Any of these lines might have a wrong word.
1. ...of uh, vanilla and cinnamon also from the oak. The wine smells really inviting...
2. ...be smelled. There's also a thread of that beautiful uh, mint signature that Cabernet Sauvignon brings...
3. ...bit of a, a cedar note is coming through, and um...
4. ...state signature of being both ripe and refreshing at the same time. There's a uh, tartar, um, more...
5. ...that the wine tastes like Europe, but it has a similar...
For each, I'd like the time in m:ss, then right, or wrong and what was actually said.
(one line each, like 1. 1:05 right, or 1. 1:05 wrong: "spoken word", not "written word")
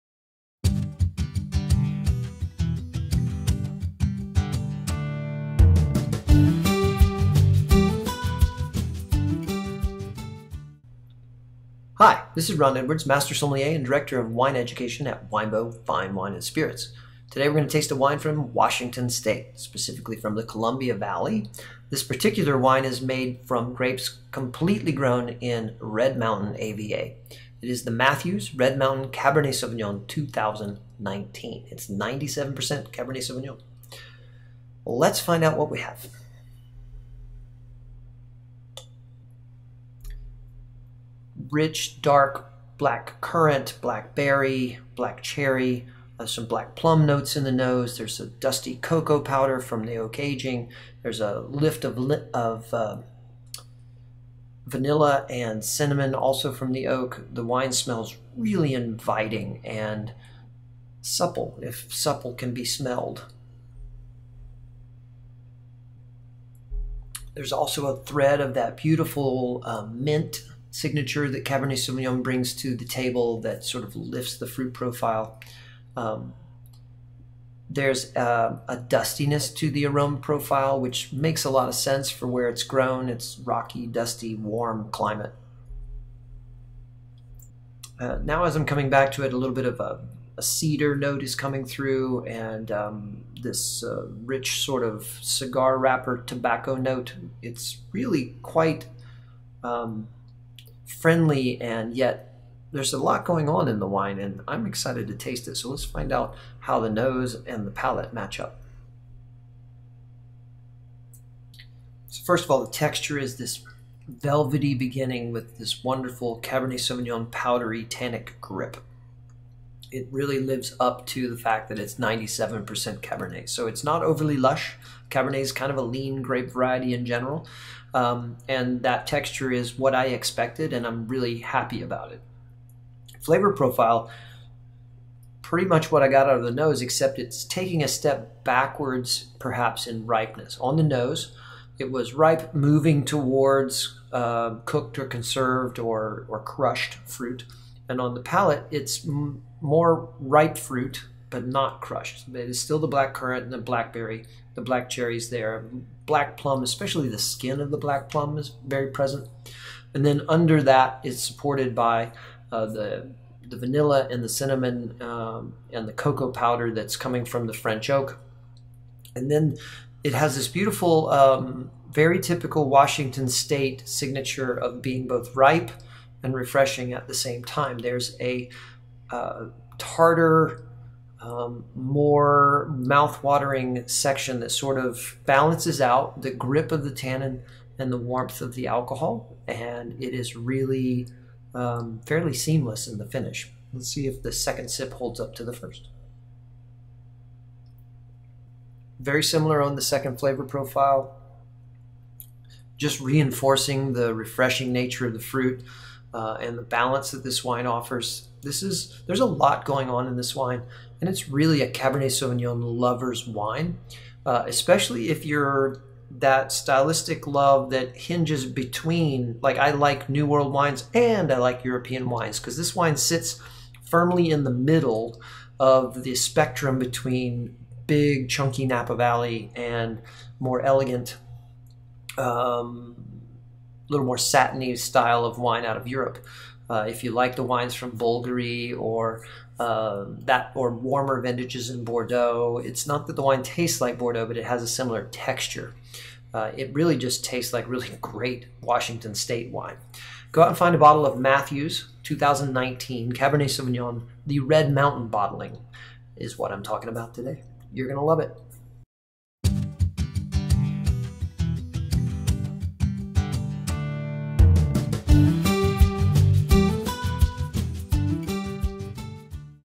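1. 0:52 right
2. 1:02 right
3. 1:29 right
4. 2:53 right
5. 4:03 wrong: "Bordeaux", not "Europe".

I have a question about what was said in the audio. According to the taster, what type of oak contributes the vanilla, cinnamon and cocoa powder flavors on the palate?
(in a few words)
French oak.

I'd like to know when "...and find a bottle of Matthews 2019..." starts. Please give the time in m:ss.
4:10.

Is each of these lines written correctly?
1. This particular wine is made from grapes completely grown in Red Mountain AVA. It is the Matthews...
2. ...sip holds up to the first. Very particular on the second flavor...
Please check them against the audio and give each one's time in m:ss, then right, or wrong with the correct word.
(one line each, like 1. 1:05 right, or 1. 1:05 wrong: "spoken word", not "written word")
1. 0:21 right
2. 3:14 wrong: "similar", not "particular".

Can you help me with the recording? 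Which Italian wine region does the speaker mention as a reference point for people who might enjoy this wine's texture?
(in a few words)
Bolgheri.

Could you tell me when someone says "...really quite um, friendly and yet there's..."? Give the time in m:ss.
1:37.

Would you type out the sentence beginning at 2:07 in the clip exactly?
Um, and that texture is what I expected, and I'm really happy about it.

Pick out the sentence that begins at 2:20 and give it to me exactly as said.
On the nose, it was ripe, moving towards uh, cooked or conserved or, or crushed fruit.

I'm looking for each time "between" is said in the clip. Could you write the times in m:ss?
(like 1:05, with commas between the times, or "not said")
3:38, 3:46.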